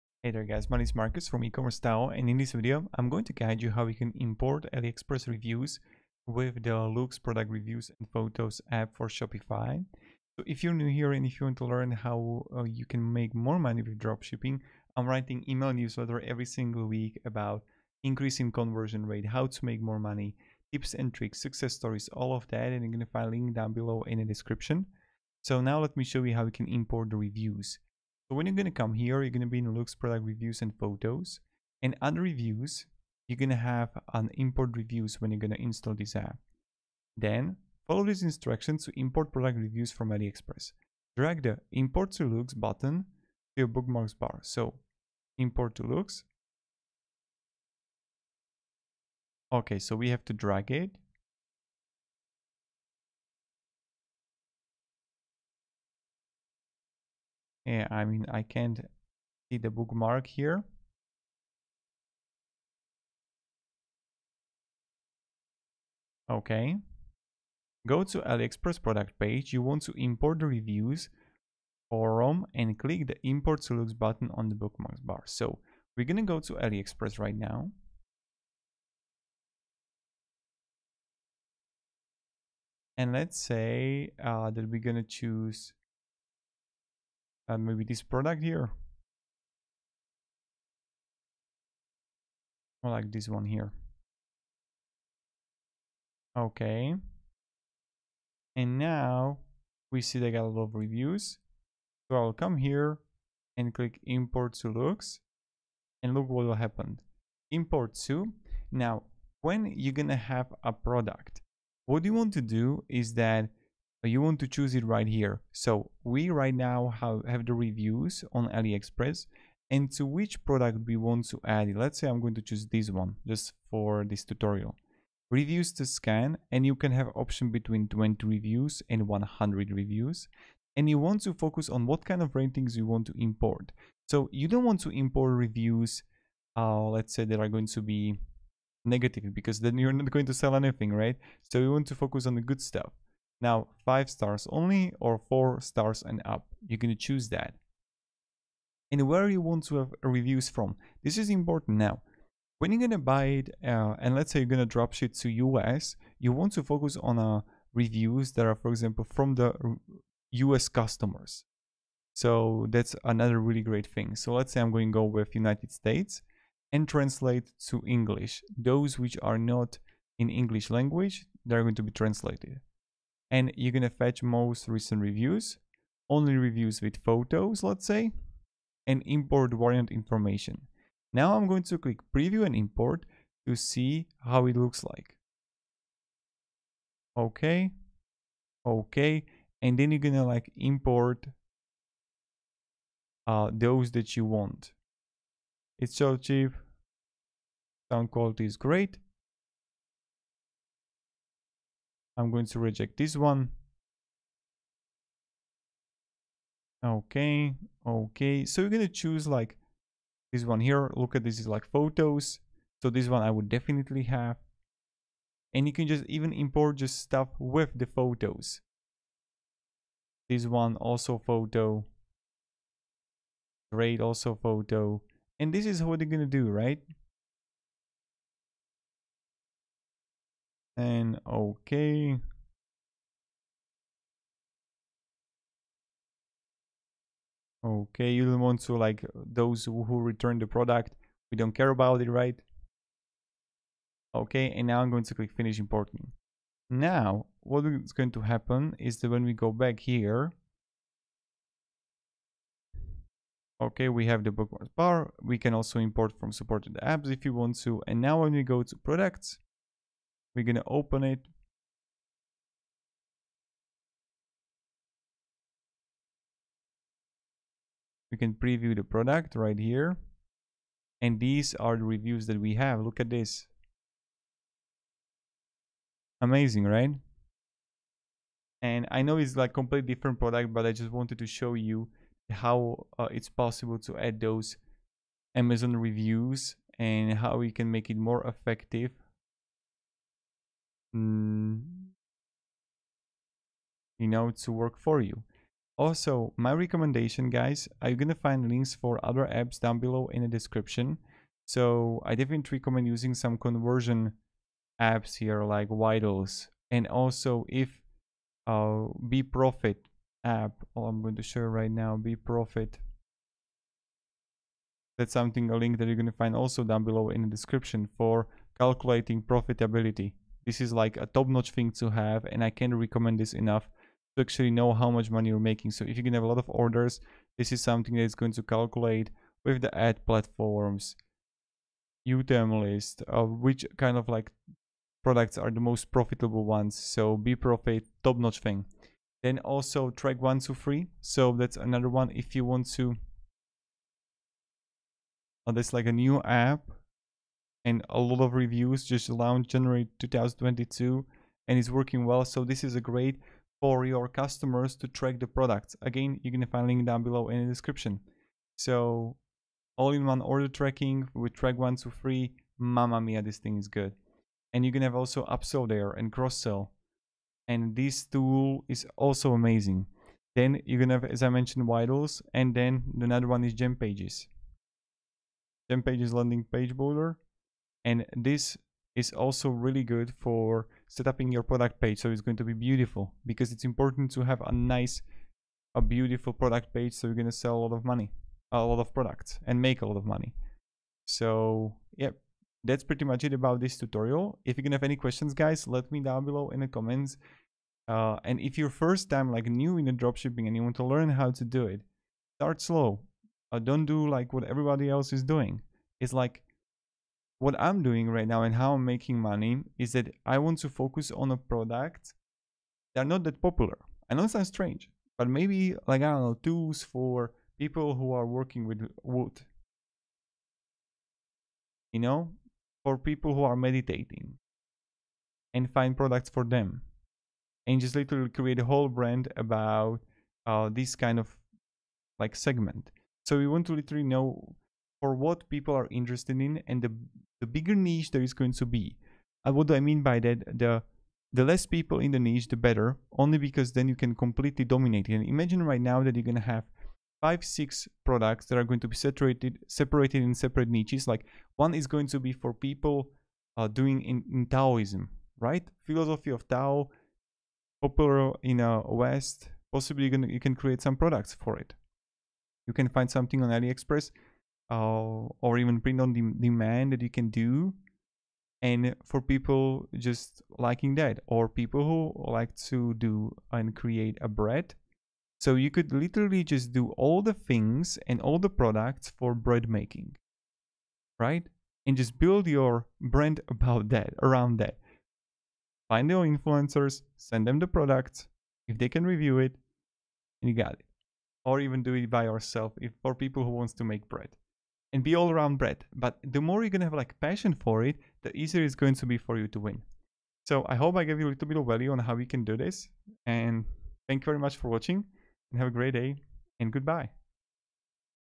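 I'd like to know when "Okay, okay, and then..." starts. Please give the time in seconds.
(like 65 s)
187 s.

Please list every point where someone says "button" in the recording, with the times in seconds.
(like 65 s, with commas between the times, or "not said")
42 s, 73 s.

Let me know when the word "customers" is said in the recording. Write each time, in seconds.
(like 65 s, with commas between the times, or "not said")
160 s, 354 s.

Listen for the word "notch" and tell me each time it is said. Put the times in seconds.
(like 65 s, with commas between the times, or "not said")
321 s, 338 s.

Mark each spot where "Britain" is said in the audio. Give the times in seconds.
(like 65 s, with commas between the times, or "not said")
not said.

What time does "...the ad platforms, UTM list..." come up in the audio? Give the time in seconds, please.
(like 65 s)
329 s.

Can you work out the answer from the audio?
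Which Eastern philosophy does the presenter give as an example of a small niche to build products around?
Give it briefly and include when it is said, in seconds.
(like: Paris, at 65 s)
Taoism, at 454 s.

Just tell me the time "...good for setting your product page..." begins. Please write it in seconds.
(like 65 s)
379 s.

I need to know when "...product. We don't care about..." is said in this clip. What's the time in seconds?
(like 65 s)
240 s.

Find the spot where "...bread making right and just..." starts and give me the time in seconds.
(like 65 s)
479 s.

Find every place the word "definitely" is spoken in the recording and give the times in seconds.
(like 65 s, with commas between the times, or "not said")
213 s, 302 s.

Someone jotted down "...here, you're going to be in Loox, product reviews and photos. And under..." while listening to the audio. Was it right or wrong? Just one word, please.
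right.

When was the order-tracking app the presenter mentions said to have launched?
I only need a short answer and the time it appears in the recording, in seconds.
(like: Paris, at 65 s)
January 2022, at 349 s.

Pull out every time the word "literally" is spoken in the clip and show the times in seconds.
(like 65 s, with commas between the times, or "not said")
427 s, 433 s, 475 s.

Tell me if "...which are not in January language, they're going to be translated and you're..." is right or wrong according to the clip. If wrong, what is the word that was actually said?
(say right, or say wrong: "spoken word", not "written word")
wrong: "English", not "January".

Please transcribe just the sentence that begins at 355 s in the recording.
Again, you can find link down below in the description.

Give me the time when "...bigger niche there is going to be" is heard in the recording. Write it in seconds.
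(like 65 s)
437 s.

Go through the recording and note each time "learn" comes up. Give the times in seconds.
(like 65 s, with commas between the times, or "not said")
11 s, 400 s.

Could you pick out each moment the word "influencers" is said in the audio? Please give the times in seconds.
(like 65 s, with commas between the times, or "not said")
486 s.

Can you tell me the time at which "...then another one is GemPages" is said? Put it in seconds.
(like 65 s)
372 s.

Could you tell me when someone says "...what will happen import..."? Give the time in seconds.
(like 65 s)
106 s.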